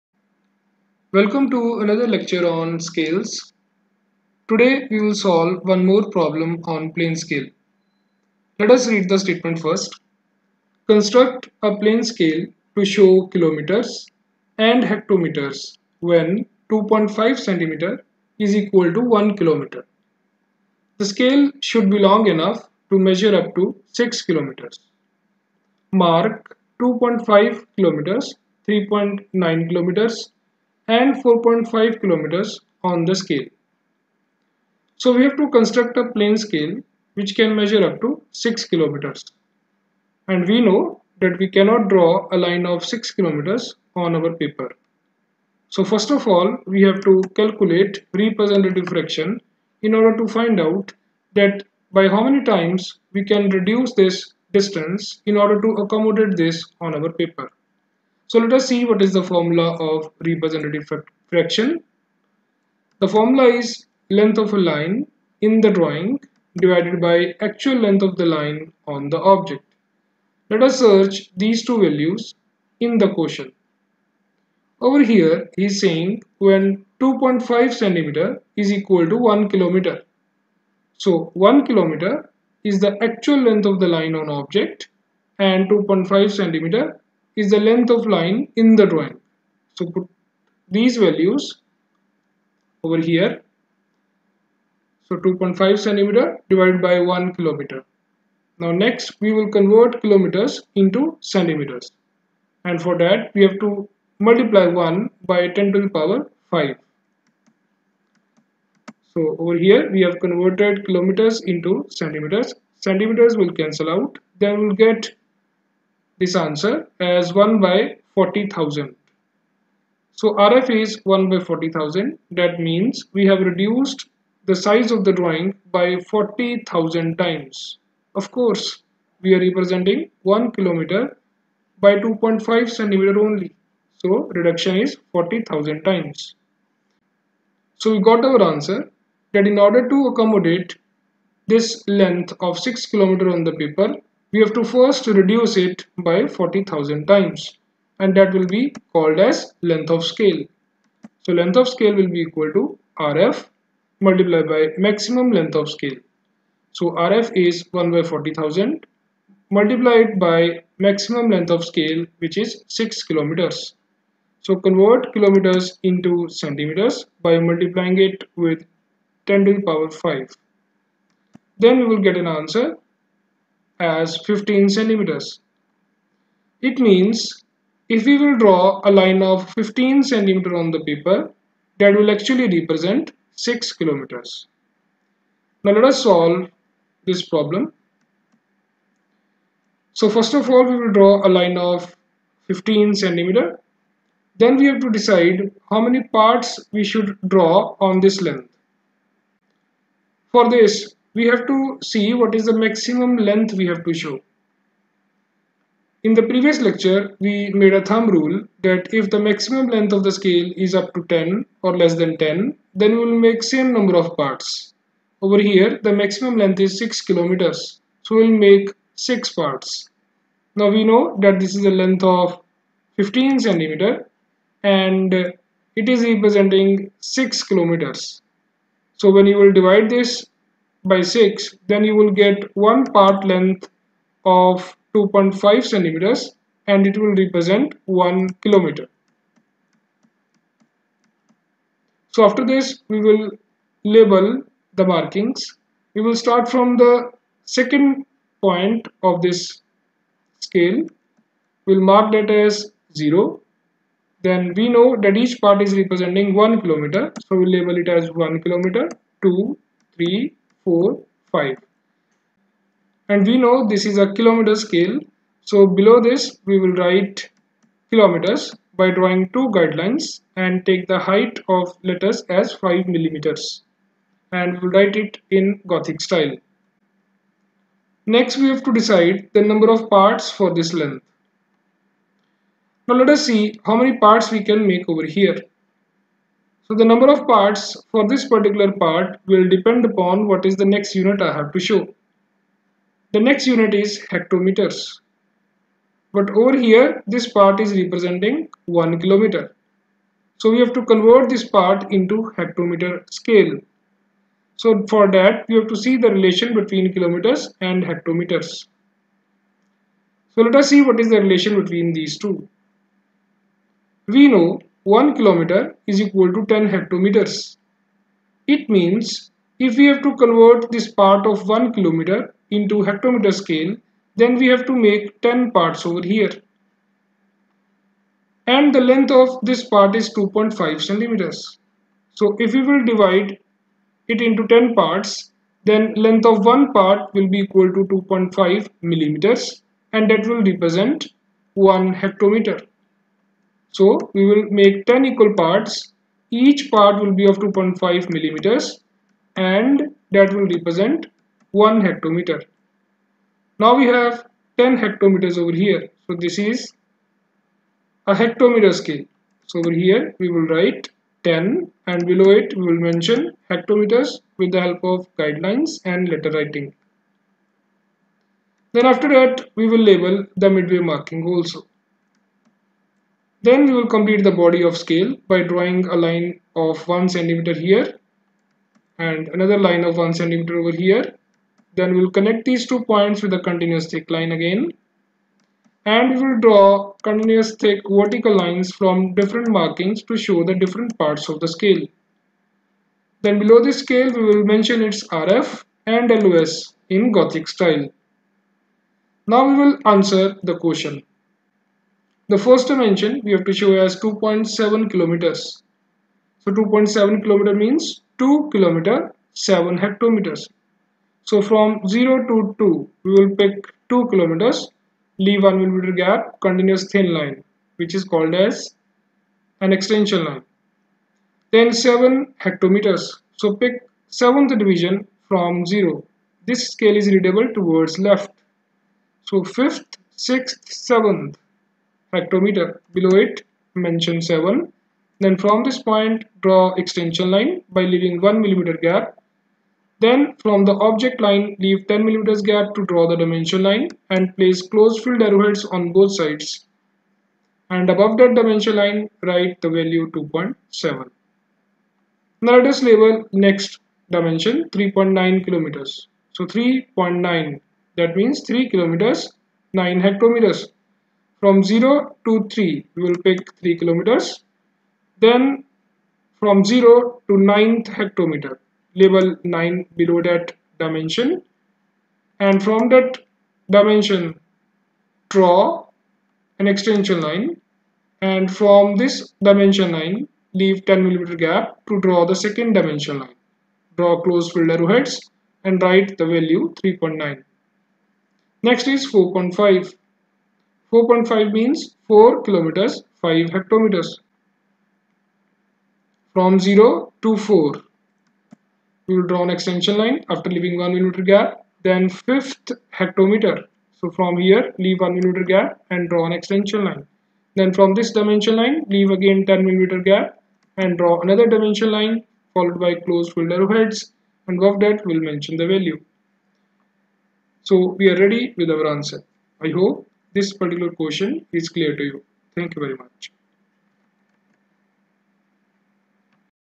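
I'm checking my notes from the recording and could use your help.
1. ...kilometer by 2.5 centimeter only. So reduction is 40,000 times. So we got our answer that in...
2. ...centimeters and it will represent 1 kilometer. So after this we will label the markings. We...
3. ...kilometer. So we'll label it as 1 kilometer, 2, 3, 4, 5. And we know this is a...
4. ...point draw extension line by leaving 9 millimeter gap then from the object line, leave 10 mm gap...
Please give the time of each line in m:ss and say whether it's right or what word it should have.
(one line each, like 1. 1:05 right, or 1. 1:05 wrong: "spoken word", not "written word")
1. 2:10 right
2. 3:55 right
3. 4:16 right
4. 7:15 wrong: "1", not "9".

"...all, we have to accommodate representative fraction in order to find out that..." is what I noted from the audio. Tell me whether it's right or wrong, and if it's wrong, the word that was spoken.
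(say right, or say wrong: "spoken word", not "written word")
wrong: "calculate", not "accommodate".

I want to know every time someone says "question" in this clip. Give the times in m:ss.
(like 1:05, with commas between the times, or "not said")
6:40, 8:40.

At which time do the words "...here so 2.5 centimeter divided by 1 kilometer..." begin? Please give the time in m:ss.
1:32.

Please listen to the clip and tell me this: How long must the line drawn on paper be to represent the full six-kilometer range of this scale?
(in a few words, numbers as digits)
15 centimeters.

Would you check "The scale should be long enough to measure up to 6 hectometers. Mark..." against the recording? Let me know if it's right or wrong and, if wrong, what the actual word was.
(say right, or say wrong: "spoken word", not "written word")
wrong: "kilometers", not "hectometers".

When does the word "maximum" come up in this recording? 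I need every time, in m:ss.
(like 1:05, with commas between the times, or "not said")
2:34, 2:40, 3:22, 3:29, 3:35.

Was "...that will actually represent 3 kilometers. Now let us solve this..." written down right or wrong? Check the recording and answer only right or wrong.
wrong.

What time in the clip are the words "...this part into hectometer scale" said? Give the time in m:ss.
5:01.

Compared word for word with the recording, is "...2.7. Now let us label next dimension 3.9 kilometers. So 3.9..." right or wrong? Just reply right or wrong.
right.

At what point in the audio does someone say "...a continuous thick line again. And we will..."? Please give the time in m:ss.
6:23.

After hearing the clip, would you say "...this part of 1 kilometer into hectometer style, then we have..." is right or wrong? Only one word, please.
wrong.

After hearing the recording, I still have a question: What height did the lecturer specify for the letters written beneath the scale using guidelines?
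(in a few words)
5 millimeters.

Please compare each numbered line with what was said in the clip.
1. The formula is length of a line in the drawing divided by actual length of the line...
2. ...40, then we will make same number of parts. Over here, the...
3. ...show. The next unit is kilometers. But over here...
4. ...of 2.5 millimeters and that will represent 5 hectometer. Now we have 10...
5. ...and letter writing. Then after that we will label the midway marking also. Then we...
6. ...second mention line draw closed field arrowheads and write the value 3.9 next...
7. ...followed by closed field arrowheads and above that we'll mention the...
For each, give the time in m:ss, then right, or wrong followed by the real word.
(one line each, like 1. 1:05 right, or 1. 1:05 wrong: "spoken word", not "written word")
1. 1:02 right
2. 3:32 wrong: "10", not "40"
3. 4:51 wrong: "hectometers", not "kilometers"
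4. 5:47 wrong: "1", not "5"
5. 6:05 right
6. 8:02 wrong: "dimension", not "mention"
7. 8:32 right.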